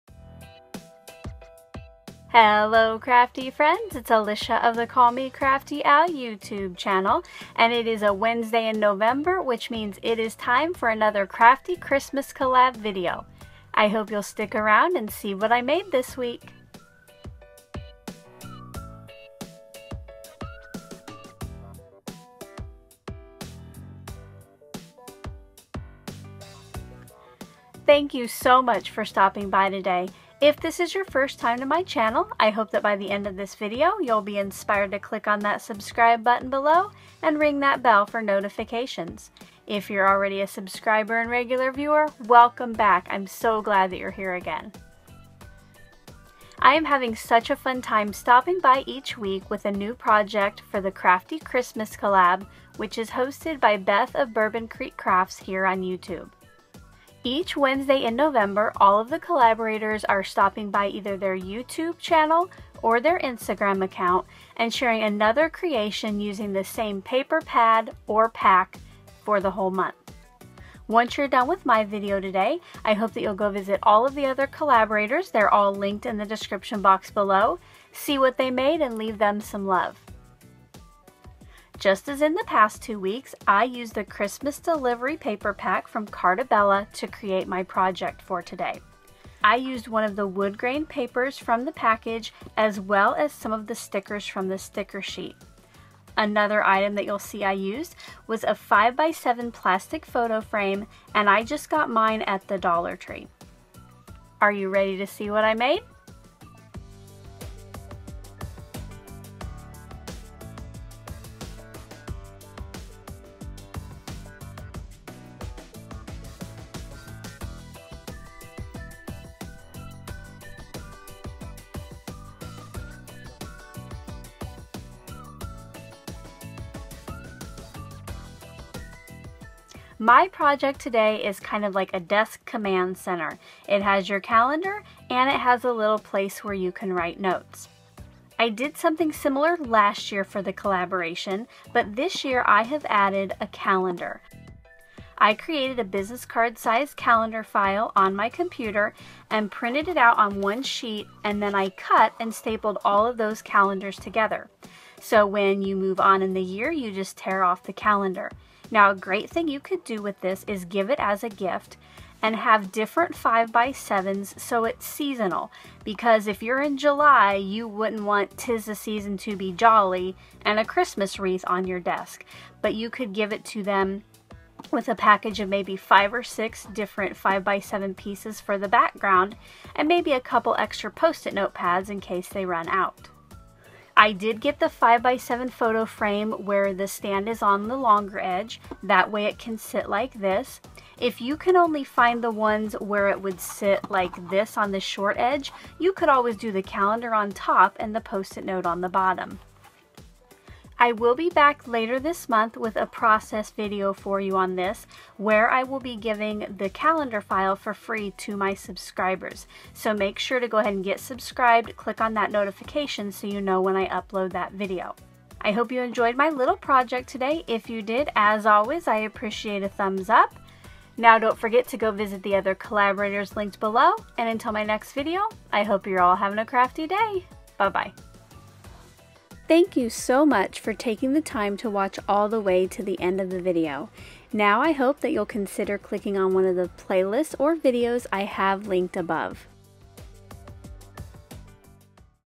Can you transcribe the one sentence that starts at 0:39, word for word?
If you're already a subscriber and regular viewer, welcome back.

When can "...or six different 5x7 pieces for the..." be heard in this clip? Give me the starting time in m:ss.
2:56.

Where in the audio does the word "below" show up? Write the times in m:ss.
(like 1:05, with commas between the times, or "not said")
0:36, 1:17, 3:43.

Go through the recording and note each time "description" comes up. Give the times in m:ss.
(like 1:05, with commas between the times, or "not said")
1:16.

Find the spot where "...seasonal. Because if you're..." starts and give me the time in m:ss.
2:44.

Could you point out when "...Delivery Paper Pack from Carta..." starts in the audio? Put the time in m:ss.
1:24.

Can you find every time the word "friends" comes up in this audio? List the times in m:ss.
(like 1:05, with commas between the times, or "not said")
0:03.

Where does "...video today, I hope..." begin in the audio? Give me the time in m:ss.
1:11.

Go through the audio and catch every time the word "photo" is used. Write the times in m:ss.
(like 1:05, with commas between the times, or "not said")
1:40, 3:05.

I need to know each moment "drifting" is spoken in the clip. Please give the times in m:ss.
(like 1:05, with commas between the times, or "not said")
not said.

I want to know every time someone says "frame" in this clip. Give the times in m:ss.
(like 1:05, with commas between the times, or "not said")
1:40, 3:05.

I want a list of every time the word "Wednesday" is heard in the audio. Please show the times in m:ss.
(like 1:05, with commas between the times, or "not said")
0:08, 0:57.